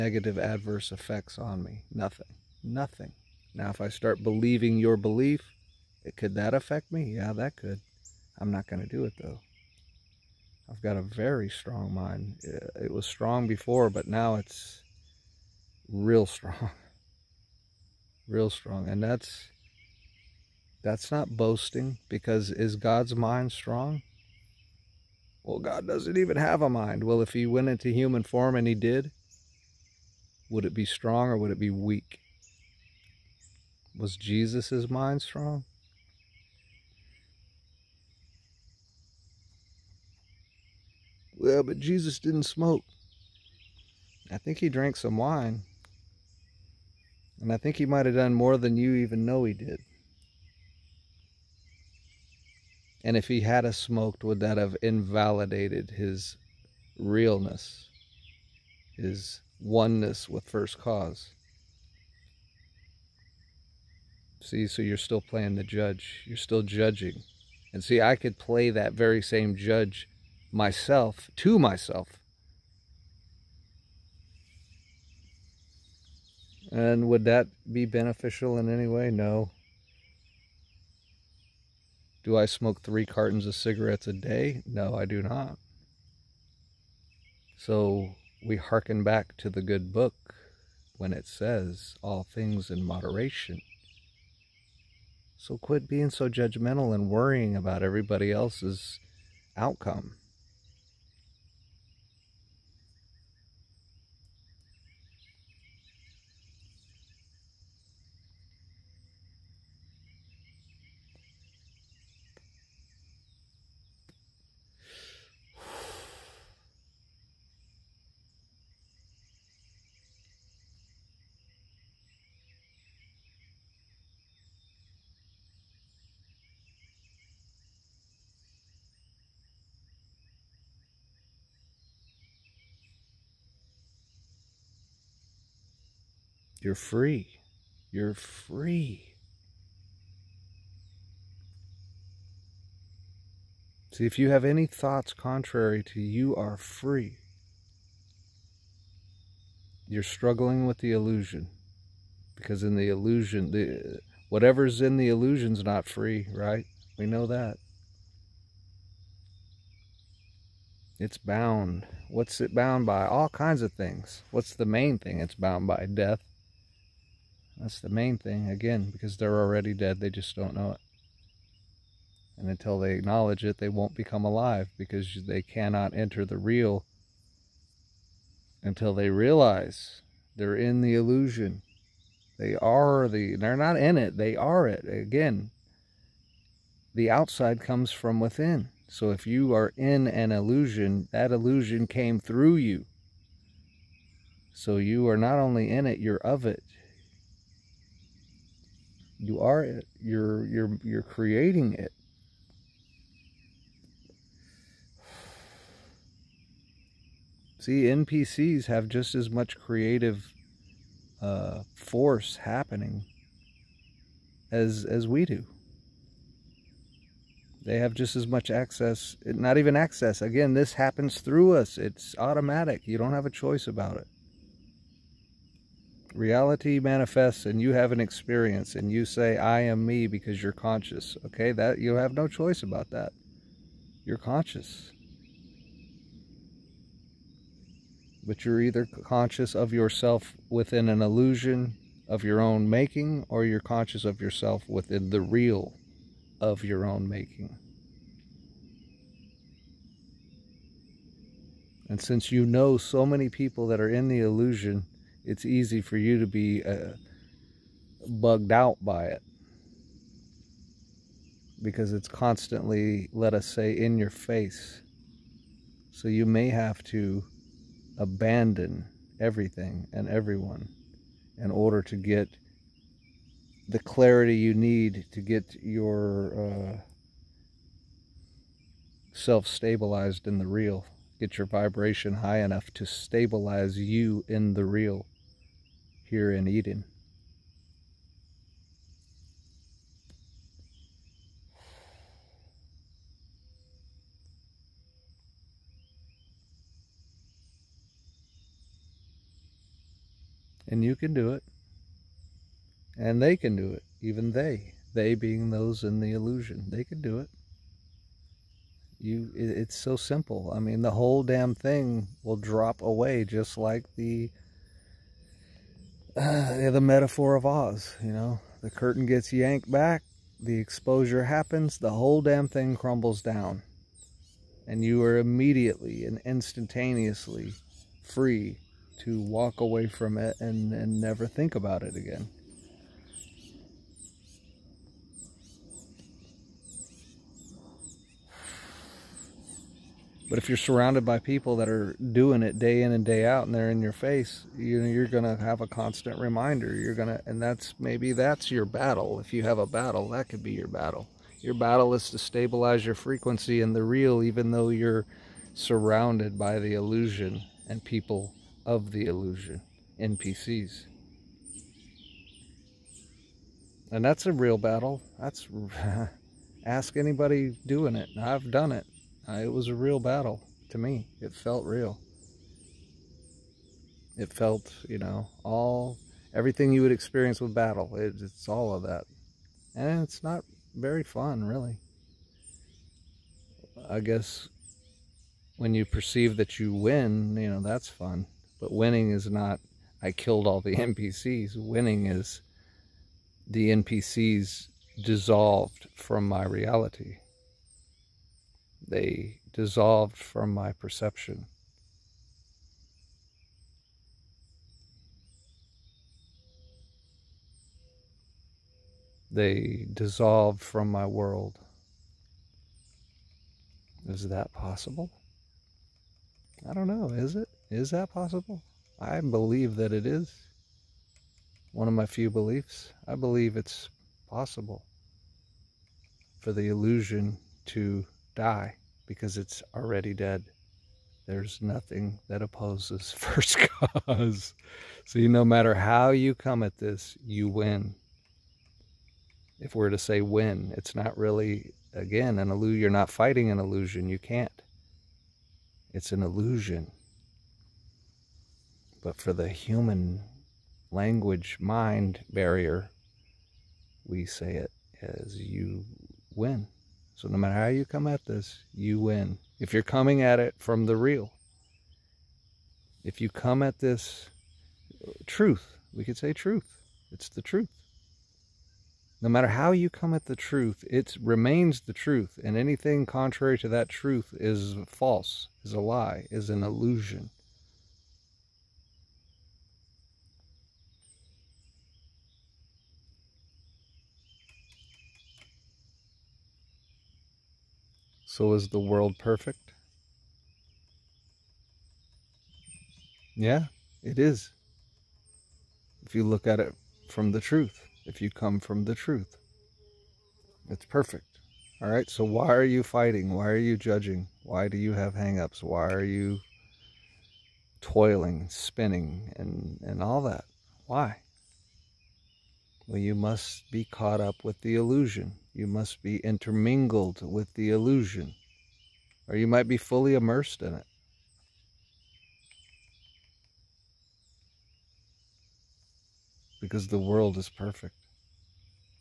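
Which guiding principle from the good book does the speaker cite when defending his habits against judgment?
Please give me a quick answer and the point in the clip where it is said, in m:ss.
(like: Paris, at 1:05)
All things in moderation, at 1:32.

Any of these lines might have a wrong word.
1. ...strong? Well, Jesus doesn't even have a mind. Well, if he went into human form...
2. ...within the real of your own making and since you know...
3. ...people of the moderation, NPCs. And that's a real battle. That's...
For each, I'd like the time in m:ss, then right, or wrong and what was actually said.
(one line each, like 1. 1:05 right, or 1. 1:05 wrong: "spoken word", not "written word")
1. 0:23 wrong: "God", not "Jesus"
2. 4:04 right
3. 5:57 wrong: "illusion", not "moderation".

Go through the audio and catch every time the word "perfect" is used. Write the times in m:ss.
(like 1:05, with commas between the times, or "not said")
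8:09, 8:20, 8:47.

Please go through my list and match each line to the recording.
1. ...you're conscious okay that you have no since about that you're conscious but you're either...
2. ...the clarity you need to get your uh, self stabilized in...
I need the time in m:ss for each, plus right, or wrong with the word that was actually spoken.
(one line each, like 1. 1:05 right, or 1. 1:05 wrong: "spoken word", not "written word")
1. 3:50 wrong: "choice", not "since"
2. 4:33 right.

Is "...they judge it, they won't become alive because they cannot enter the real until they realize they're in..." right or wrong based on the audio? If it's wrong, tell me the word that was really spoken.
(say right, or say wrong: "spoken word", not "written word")
wrong: "acknowledge", not "judge".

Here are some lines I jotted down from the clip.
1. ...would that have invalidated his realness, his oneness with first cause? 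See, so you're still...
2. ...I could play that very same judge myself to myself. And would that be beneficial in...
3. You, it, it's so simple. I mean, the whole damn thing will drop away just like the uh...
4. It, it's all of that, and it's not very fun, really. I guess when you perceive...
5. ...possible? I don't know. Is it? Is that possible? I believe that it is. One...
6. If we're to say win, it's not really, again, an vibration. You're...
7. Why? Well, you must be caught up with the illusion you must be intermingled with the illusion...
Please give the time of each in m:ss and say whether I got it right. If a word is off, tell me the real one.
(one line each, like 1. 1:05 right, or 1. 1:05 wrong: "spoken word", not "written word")
1. 0:54 right
2. 1:08 right
3. 5:08 right
4. 6:17 right
5. 6:54 right
6. 7:19 wrong: "illusion", not "vibration"
7. 8:30 right.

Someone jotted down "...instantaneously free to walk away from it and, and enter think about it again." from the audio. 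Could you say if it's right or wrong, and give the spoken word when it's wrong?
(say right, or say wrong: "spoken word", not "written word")
wrong: "never", not "enter".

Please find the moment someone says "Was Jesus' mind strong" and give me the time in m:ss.
0:33.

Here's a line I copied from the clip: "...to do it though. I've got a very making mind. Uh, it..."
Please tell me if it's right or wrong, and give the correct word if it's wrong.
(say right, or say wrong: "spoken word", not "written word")
wrong: "strong", not "making".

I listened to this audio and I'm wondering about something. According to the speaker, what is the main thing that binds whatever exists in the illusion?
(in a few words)
Death.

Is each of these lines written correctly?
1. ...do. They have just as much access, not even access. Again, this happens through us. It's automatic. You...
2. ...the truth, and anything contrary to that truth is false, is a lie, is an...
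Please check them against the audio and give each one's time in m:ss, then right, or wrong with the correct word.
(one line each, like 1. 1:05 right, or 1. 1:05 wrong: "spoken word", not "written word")
1. 3:35 right
2. 7:51 right.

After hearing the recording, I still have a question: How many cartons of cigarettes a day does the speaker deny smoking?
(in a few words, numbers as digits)
3 cartons.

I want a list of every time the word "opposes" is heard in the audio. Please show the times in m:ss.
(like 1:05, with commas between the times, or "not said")
7:12.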